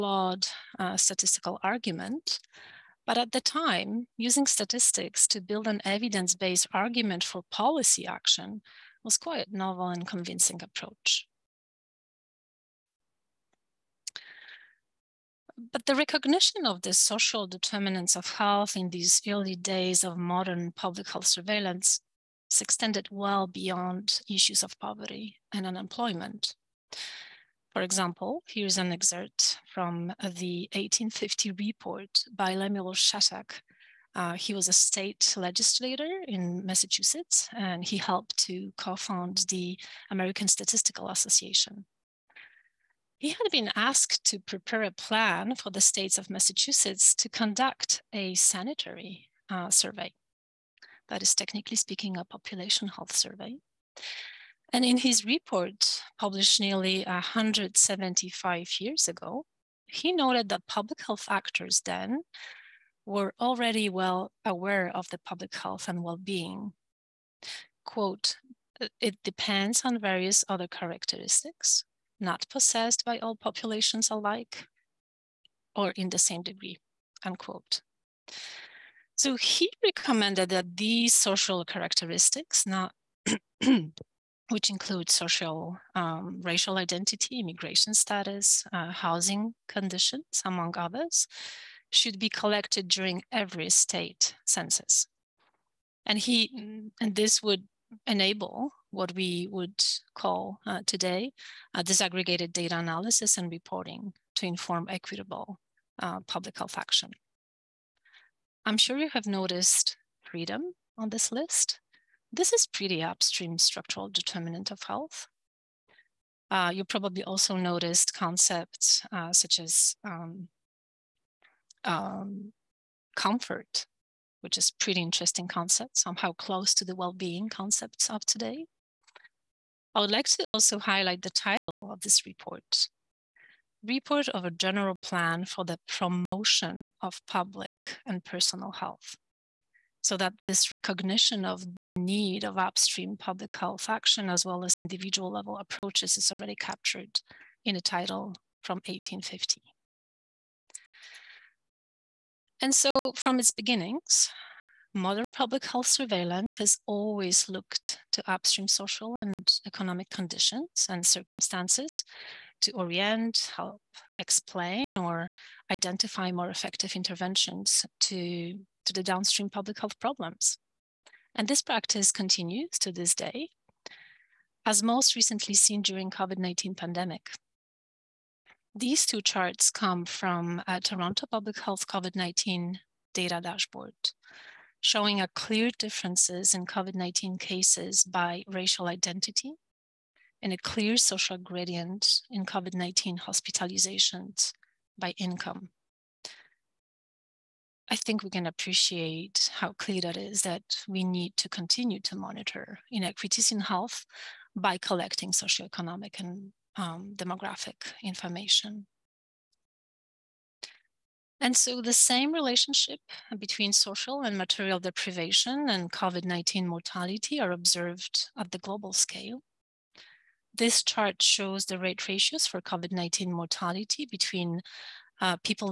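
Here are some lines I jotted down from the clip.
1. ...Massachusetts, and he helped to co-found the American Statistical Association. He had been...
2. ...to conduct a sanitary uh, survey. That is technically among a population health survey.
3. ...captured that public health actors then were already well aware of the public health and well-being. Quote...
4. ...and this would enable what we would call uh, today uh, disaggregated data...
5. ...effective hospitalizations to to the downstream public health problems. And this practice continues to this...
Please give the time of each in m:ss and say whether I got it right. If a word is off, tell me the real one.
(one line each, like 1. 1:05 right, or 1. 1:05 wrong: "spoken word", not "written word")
1. 0:36 right
2. 0:47 wrong: "speaking", not "among"
3. 1:00 wrong: "noted", not "captured"
4. 1:37 right
5. 2:46 wrong: "interventions", not "hospitalizations".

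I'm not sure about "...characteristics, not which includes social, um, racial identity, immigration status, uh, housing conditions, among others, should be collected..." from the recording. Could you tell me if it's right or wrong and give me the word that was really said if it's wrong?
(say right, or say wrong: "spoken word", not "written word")
right.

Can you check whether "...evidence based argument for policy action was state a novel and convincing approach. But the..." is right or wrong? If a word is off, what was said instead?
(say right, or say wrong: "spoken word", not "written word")
wrong: "quite", not "state".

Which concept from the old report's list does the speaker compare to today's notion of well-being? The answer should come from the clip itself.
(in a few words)
comfort.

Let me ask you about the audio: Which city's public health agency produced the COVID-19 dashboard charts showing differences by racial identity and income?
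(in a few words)
Toronto.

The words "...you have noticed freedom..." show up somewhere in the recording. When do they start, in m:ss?
1:48.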